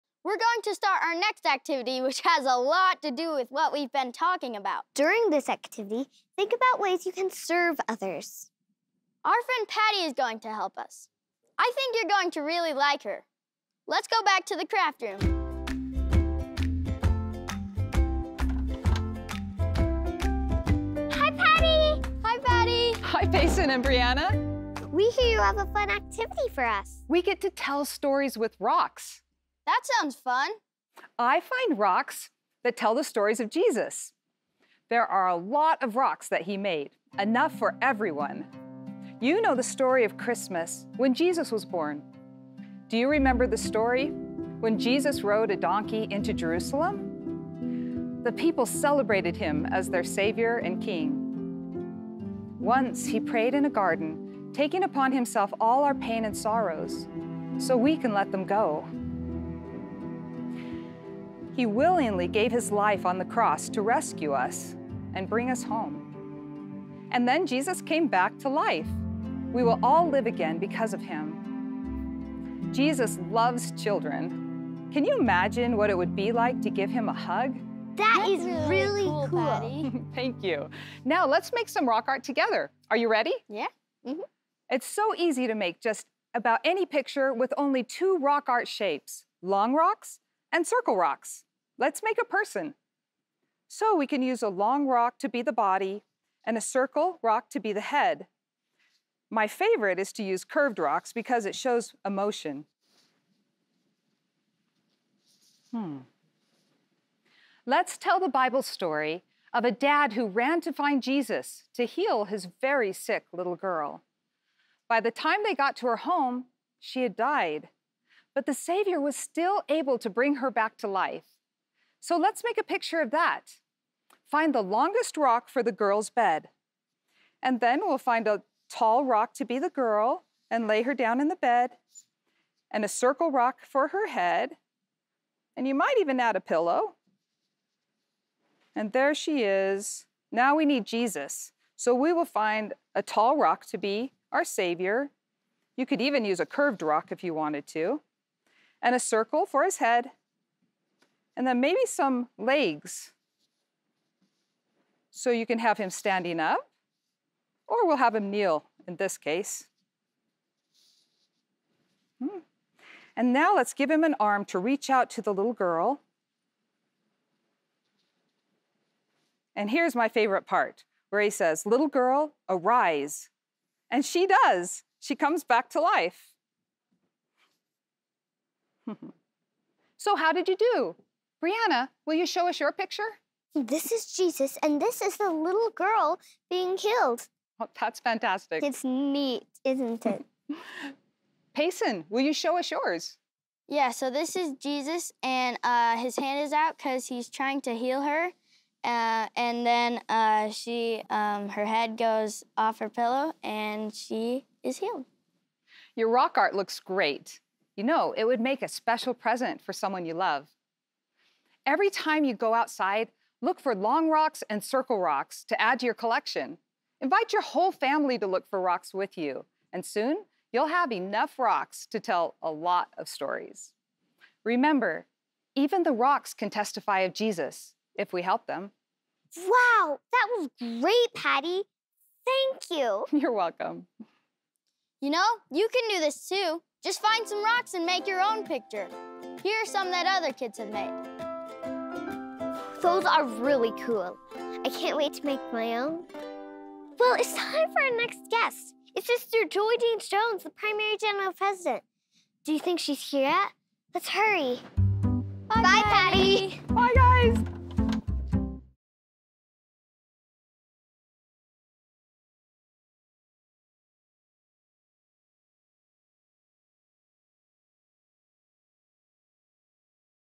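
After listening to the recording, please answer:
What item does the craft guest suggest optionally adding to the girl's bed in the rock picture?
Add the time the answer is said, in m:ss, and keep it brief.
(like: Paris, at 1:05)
a pillow, at 2:16.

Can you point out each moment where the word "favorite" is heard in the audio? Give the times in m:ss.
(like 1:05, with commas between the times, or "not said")
1:39, 2:50.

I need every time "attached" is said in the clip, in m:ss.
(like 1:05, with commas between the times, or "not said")
not said.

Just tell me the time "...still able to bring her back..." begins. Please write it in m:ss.
1:59.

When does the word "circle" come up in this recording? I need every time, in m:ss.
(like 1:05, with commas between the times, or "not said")
1:30, 1:36, 2:12, 2:28, 3:34.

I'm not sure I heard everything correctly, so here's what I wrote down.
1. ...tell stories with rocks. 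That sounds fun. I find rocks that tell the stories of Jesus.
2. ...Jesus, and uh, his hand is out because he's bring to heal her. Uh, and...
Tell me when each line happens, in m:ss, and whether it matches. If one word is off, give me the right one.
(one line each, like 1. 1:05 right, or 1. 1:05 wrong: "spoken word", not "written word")
1. 0:27 right
2. 3:14 wrong: "trying", not "bring".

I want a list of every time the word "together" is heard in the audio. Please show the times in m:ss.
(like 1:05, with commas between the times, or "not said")
1:22.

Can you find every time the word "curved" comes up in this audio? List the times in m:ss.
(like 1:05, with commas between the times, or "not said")
1:40, 2:26.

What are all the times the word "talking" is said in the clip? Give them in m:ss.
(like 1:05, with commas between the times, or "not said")
0:04.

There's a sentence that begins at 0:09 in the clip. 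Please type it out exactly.
Our friend Patty is going to help us.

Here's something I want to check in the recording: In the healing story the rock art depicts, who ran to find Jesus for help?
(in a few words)
a dad.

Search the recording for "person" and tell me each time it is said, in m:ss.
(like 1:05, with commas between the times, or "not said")
1:32.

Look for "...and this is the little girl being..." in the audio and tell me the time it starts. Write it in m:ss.
3:04.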